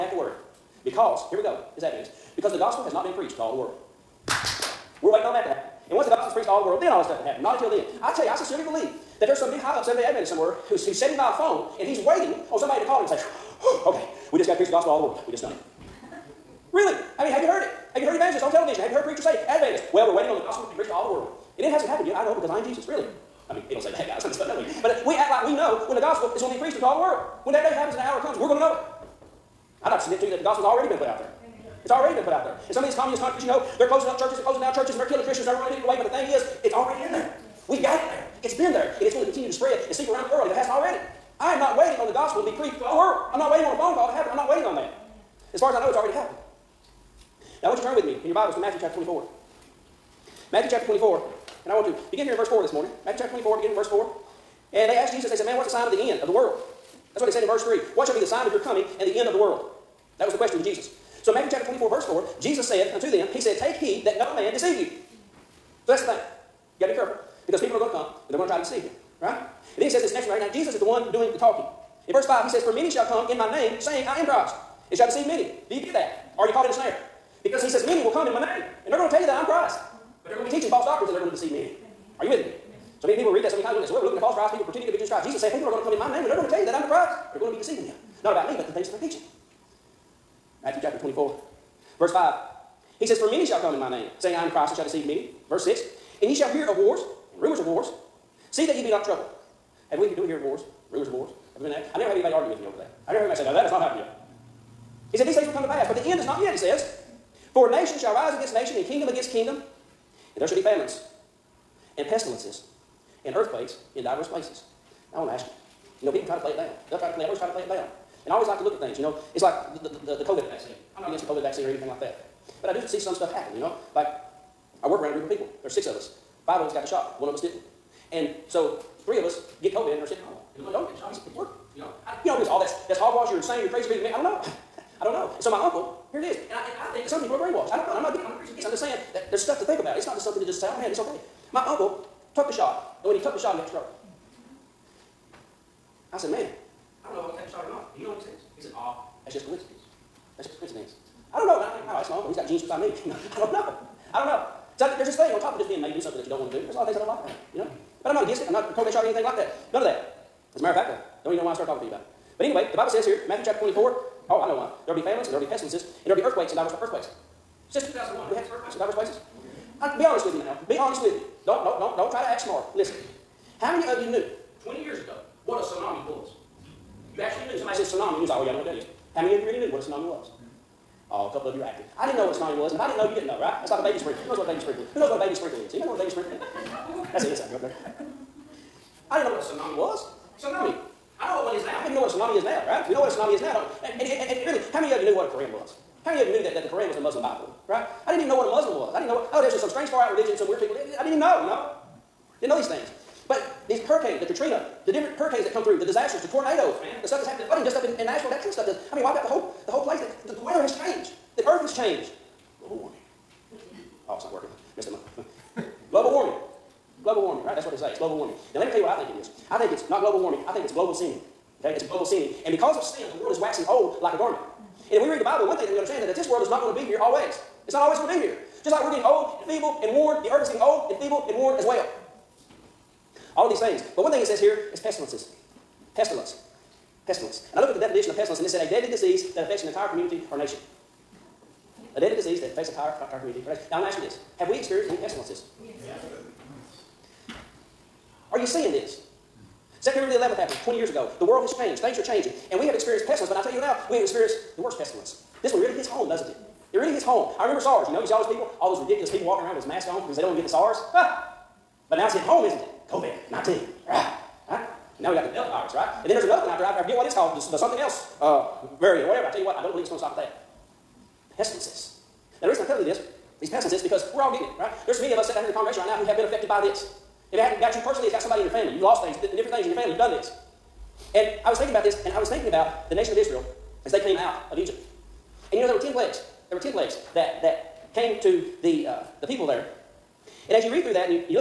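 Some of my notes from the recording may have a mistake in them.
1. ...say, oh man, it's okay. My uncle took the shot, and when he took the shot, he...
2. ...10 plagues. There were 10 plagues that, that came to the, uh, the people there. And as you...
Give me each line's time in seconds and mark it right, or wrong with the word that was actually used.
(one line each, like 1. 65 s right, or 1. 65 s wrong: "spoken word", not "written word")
1. 140 s right
2. 285 s right.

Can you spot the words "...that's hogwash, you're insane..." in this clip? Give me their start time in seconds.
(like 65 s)
132 s.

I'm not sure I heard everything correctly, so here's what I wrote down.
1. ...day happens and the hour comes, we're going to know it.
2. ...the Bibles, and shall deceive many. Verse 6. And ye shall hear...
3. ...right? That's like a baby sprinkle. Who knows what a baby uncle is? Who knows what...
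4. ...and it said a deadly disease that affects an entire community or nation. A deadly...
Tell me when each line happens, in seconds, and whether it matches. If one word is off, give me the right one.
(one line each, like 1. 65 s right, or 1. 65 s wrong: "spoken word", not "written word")
1. 27 s right
2. 94 s wrong: "Christ", not "Bibles"
3. 183 s wrong: "sprinkle", not "uncle"
4. 238 s right.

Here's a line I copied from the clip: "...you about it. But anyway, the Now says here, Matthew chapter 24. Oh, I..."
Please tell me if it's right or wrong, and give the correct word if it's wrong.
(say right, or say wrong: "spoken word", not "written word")
wrong: "Bible", not "Now".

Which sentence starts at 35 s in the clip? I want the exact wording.
But the thing is, it's already in there.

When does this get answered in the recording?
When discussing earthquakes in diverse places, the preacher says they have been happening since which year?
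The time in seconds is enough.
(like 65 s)
167 s.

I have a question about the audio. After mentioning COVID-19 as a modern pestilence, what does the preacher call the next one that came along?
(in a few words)
Delta virus.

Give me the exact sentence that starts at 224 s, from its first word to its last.
And if we read the Bible, one thing that we understand is that this world is not going to be here always.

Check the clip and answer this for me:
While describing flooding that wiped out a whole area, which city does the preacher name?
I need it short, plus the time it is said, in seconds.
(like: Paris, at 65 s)
Nashville, at 208 s.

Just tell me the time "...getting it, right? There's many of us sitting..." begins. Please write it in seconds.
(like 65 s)
274 s.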